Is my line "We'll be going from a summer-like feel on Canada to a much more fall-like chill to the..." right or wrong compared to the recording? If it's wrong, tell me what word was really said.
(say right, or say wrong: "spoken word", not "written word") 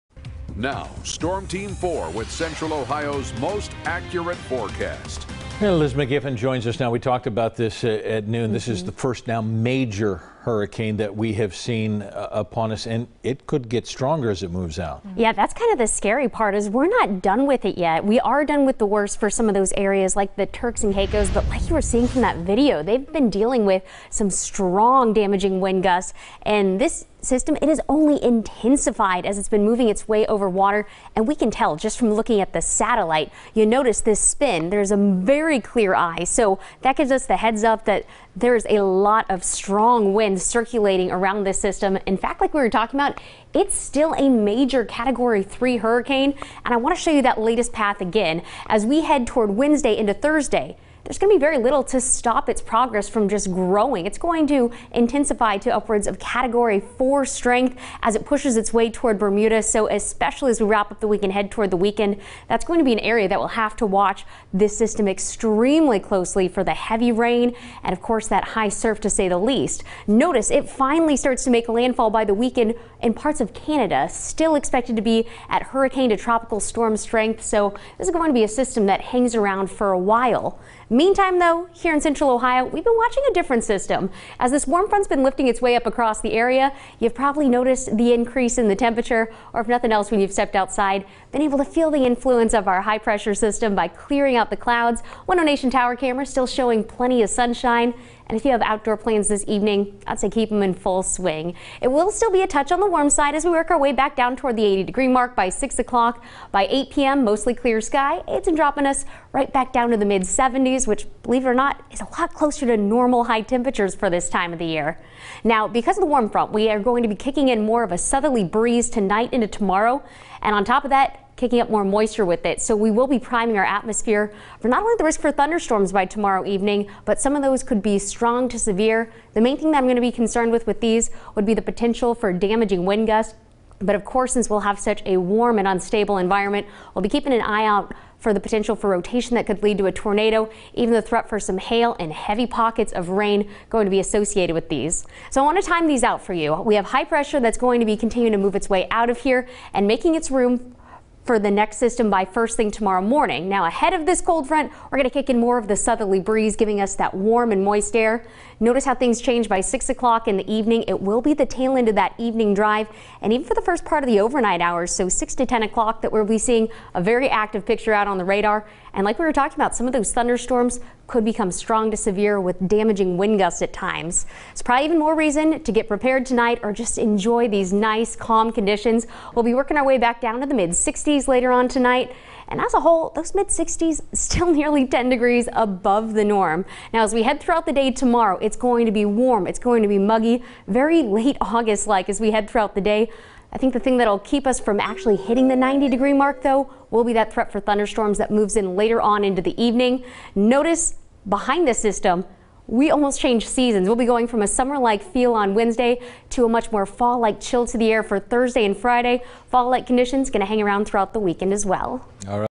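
wrong: "Wednesday", not "Canada".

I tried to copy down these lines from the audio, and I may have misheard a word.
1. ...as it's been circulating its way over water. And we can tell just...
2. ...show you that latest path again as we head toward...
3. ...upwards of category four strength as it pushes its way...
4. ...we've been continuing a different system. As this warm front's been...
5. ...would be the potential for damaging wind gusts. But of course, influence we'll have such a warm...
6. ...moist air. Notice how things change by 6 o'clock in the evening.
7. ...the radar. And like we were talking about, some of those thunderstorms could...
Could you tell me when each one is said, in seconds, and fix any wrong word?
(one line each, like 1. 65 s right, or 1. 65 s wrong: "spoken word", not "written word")
1. 29 s wrong: "moving", not "circulating"
2. 47 s right
3. 55 s right
4. 82 s wrong: "watching", not "continuing"
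5. 131 s wrong: "since", not "influence"
6. 157 s right
7. 168 s right.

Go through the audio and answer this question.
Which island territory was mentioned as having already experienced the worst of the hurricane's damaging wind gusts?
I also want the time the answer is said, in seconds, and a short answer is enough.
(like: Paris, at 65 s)
Turks and Caicos, at 20 s.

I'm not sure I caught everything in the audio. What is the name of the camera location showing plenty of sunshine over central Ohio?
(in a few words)
One Nation Tower.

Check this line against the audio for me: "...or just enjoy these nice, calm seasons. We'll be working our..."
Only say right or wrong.
wrong.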